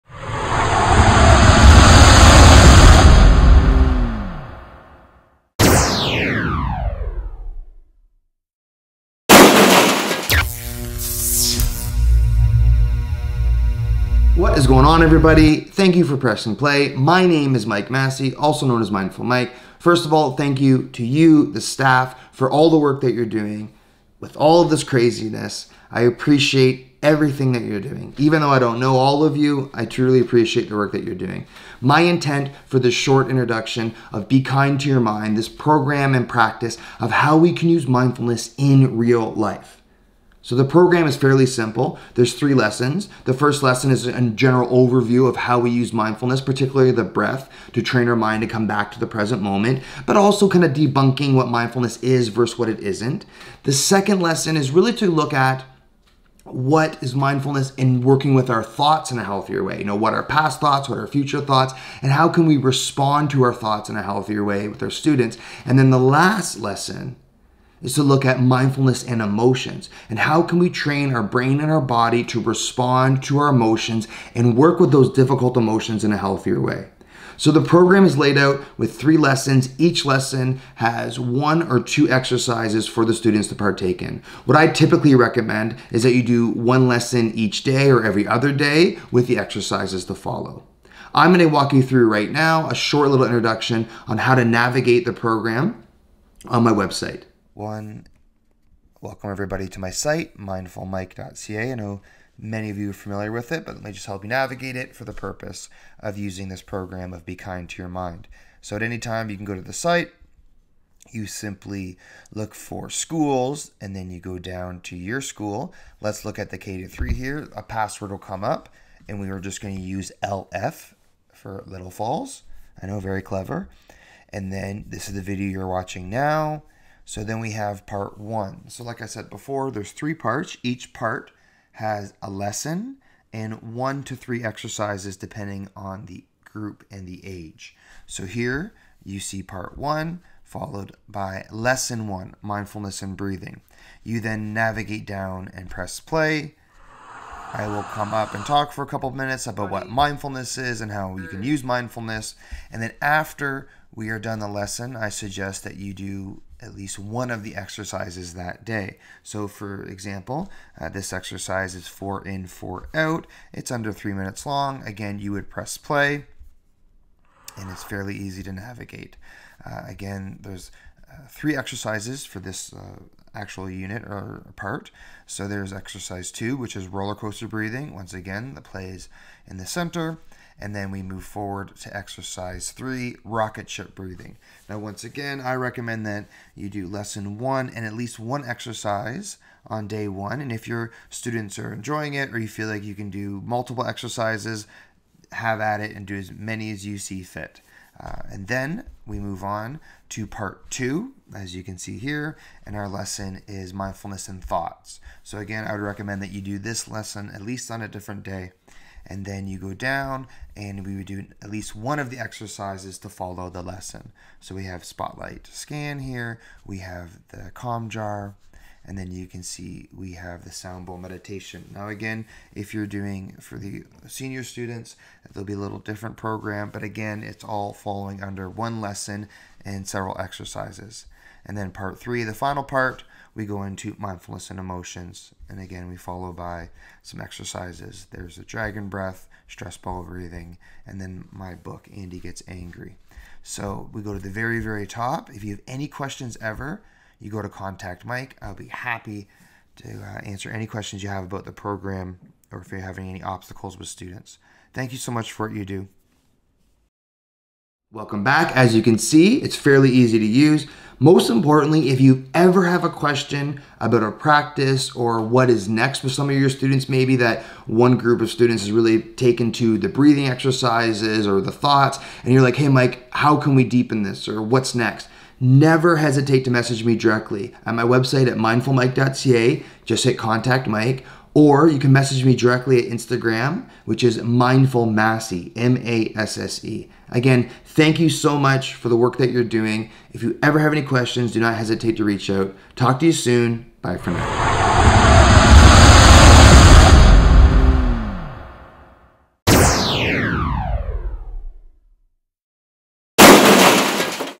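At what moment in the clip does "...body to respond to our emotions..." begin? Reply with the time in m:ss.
1:11.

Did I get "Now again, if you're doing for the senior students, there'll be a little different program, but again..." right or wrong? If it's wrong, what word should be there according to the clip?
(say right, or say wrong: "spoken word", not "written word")
right.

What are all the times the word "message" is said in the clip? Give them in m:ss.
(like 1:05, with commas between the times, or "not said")
4:36, 4:41.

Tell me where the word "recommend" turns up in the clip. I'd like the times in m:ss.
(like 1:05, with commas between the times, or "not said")
1:25, 3:05, 3:25.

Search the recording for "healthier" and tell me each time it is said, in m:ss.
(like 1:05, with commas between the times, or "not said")
0:59, 1:04, 1:16.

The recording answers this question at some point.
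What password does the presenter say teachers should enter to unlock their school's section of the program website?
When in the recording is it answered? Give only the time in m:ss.
2:00.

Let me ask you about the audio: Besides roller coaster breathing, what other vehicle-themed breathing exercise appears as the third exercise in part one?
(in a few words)
Rocket ship breathing.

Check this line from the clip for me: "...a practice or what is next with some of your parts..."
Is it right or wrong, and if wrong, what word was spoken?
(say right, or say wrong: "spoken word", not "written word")
wrong: "students", not "parts".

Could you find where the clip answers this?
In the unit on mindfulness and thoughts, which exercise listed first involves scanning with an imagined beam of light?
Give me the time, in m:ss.
3:34.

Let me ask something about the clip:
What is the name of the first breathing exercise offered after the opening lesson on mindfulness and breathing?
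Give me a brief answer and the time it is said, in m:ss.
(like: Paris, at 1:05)
Four in, four out, at 2:41.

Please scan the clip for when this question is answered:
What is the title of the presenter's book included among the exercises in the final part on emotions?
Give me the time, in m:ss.
4:01.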